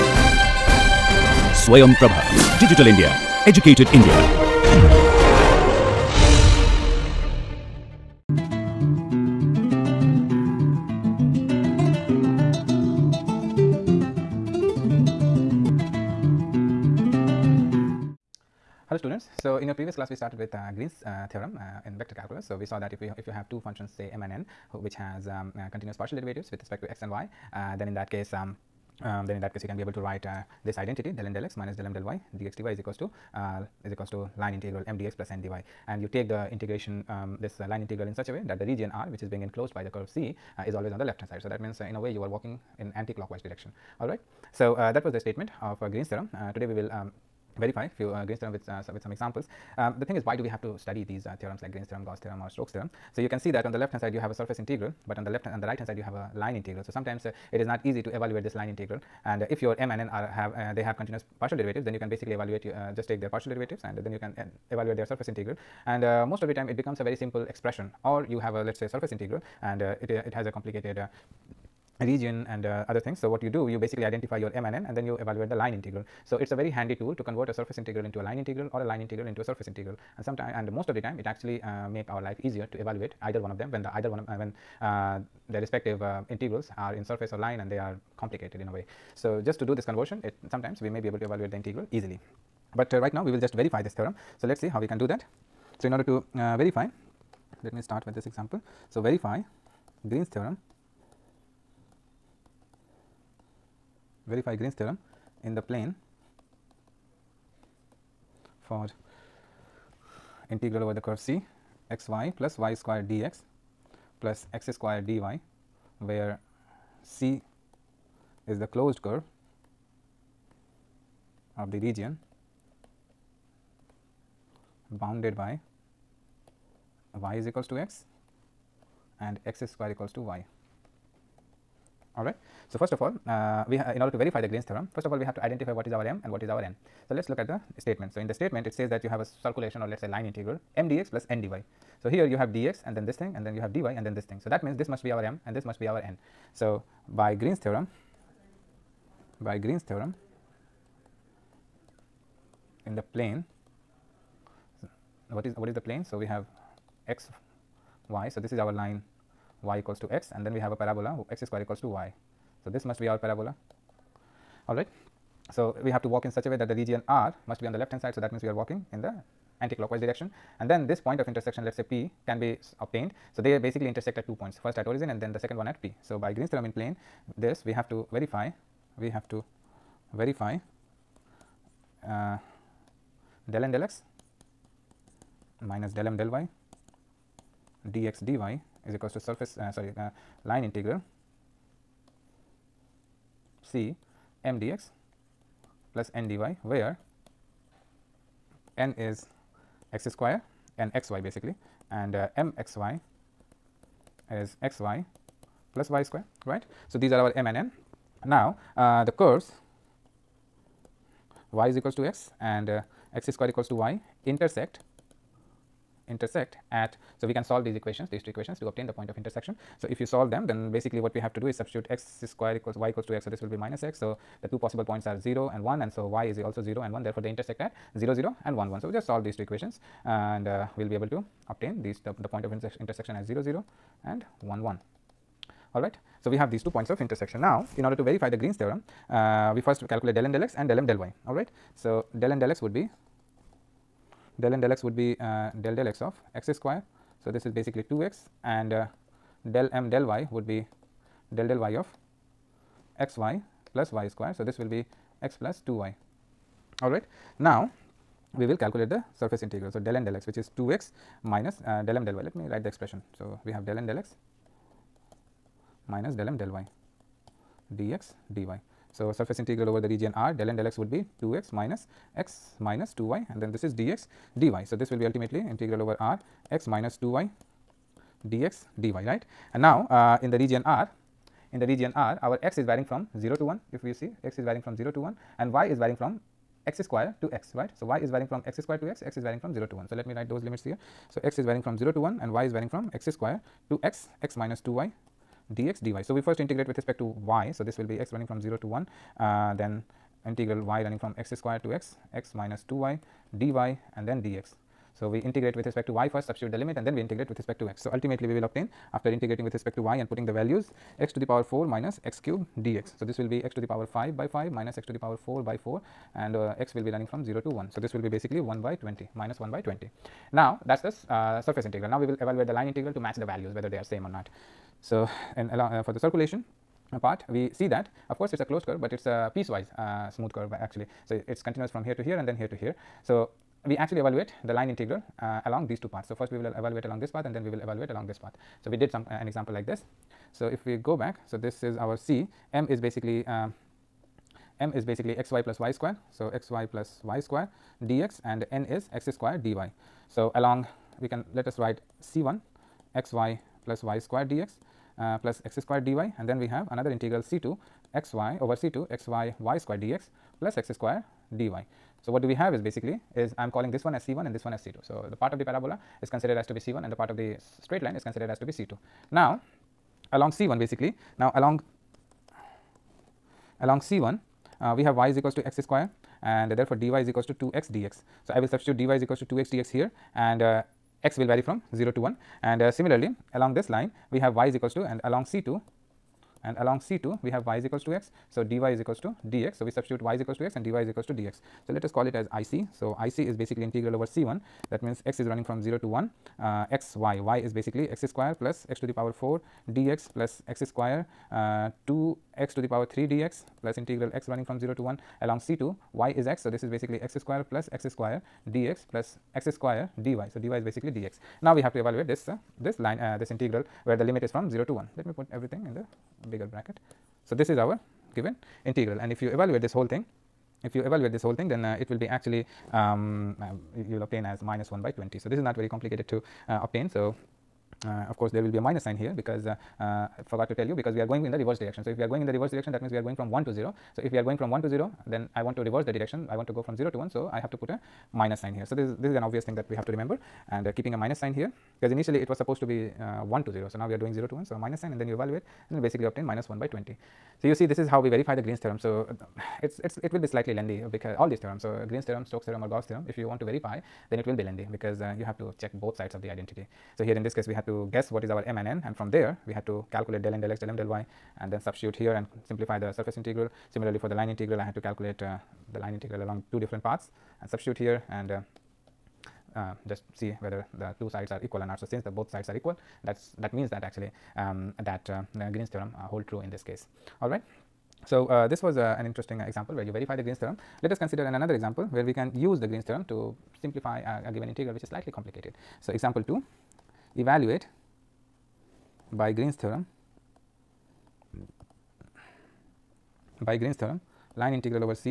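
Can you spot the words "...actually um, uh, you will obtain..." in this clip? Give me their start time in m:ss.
7:02.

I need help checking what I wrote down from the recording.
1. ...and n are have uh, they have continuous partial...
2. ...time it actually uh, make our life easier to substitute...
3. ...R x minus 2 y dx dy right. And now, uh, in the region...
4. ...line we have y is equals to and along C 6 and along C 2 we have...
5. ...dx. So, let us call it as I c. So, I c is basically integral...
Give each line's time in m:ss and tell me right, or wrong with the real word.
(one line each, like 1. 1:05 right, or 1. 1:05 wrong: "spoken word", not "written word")
1. 0:59 right
2. 1:21 wrong: "evaluate", not "substitute"
3. 4:35 right
4. 6:23 wrong: "2", not "6"
5. 6:31 right.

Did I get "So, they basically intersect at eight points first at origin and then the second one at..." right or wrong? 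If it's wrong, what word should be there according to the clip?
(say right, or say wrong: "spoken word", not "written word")
wrong: "two", not "eight".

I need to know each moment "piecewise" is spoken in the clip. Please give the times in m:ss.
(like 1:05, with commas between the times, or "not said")
5:29.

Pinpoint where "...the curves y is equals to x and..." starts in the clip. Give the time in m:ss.
3:29.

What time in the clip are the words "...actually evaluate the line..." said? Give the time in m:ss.
5:33.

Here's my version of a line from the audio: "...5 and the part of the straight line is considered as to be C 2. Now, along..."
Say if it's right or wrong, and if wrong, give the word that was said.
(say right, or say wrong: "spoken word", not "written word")
wrong: "1", not "5".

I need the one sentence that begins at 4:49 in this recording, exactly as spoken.
So, let me write those limits here.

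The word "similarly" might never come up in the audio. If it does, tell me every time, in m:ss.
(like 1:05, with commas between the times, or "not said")
6:22, 7:43.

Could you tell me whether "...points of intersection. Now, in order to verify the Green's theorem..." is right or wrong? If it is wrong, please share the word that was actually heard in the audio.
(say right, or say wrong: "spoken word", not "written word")
right.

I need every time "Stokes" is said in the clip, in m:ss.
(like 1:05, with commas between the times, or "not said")
0:52, 7:32.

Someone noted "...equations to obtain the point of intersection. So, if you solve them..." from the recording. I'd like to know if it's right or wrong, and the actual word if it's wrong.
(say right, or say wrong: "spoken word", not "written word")
right.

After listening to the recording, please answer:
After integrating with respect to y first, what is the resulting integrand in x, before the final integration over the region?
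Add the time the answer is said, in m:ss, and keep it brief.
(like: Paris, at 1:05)
x^4 - x^3, at 5:10.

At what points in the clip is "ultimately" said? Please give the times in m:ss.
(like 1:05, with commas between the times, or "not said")
4:35, 5:07.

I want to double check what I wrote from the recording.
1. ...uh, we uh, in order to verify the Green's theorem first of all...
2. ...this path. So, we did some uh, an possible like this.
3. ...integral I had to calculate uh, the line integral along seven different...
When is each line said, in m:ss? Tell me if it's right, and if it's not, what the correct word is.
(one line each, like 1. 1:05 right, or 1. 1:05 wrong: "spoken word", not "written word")
1. 2:13 right
2. 5:38 wrong: "example", not "possible"
3. 7:44 wrong: "two", not "seven".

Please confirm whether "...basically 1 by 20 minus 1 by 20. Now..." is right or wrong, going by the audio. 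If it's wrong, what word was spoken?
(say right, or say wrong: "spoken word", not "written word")
right.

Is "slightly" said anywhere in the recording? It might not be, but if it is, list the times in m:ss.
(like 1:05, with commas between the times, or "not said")
7:30, 8:04.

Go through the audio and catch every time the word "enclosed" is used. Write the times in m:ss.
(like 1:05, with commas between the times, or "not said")
0:39.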